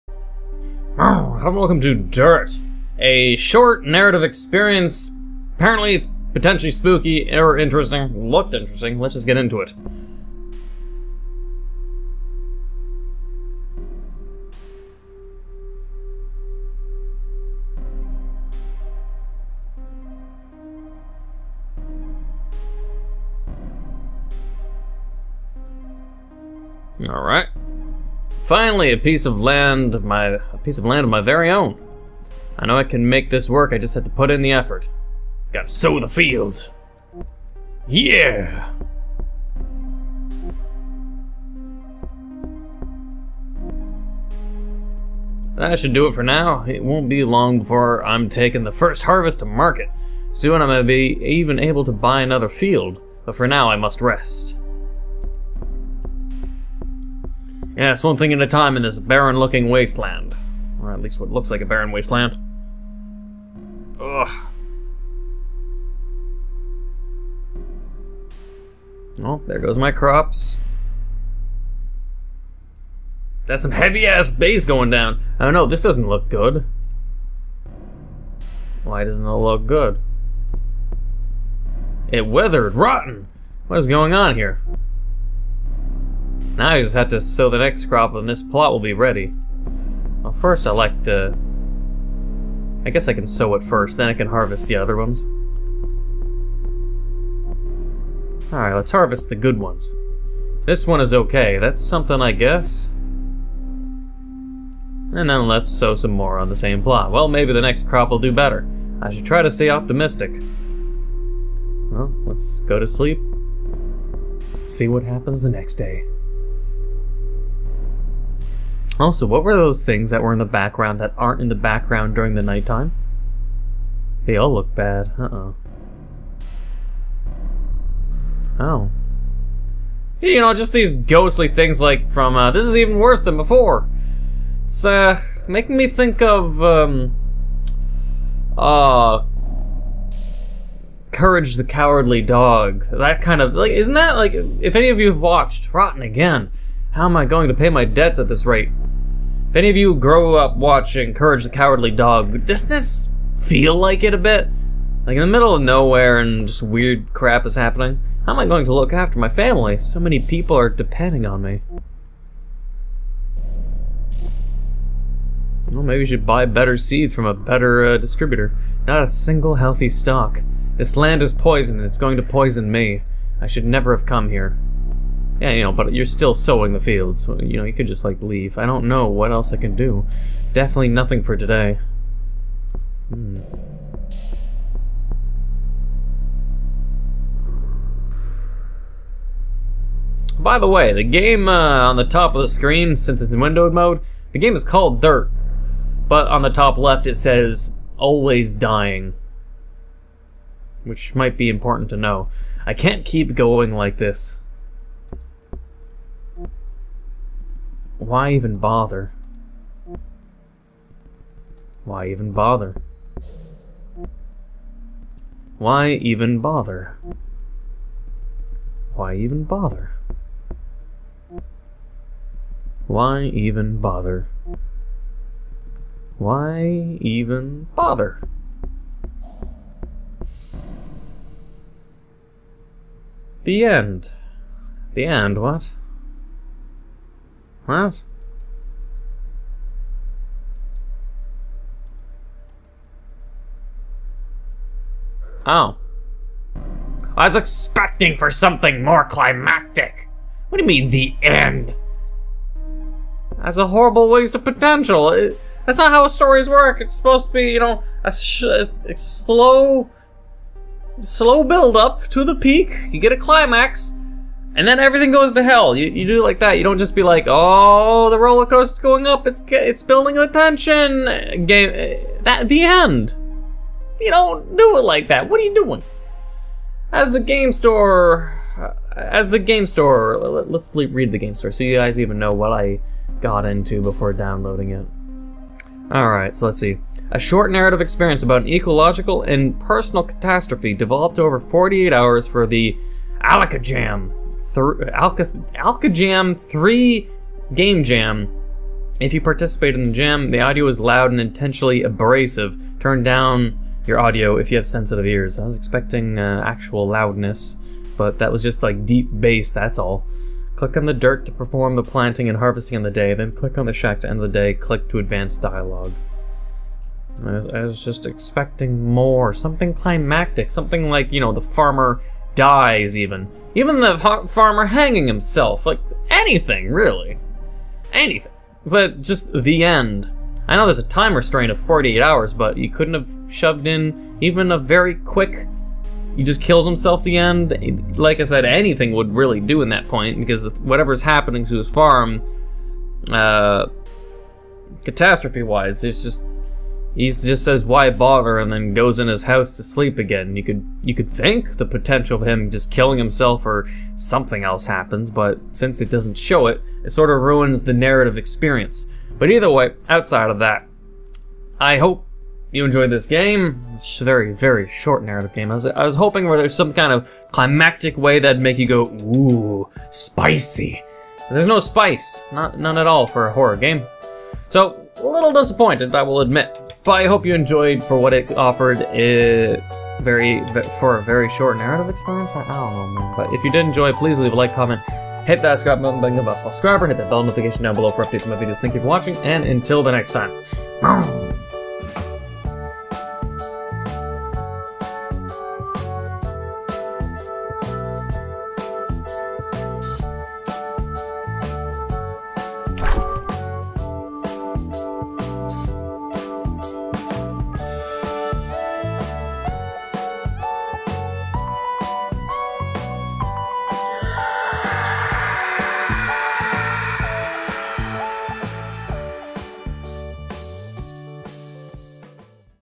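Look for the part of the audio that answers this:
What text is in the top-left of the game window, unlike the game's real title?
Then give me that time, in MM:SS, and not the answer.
03:17.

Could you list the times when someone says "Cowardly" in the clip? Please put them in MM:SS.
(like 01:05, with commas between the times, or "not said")
02:21, 02:31.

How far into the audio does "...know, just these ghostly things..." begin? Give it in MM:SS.
02:10.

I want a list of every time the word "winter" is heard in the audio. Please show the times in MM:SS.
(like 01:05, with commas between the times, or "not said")
not said.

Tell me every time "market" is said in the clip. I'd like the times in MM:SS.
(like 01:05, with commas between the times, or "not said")
00:49.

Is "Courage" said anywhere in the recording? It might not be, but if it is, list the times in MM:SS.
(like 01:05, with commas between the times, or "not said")
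02:21, 02:31.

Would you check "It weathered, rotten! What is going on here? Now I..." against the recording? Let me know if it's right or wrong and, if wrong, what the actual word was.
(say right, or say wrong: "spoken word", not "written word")
right.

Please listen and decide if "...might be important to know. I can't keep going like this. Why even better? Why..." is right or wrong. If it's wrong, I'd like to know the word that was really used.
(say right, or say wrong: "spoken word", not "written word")
wrong: "bother", not "better".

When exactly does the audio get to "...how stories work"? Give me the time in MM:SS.
04:15.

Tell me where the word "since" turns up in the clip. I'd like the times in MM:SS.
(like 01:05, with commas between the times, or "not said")
03:12, 05:55.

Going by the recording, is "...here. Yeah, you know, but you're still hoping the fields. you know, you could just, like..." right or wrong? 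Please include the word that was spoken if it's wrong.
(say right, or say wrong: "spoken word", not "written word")
wrong: "sowing", not "hoping".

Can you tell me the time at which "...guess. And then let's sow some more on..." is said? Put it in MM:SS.
01:42.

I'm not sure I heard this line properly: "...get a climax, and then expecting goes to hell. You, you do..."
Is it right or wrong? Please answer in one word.
wrong.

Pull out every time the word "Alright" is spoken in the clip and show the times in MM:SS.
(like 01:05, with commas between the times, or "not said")
01:38, 04:45.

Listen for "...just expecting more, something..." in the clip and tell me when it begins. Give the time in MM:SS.
05:17.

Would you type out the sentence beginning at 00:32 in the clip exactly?
I know I can make this work, I just have to put in the effort.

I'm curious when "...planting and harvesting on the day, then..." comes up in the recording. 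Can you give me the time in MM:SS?
05:11.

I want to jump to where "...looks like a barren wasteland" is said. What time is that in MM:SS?
01:01.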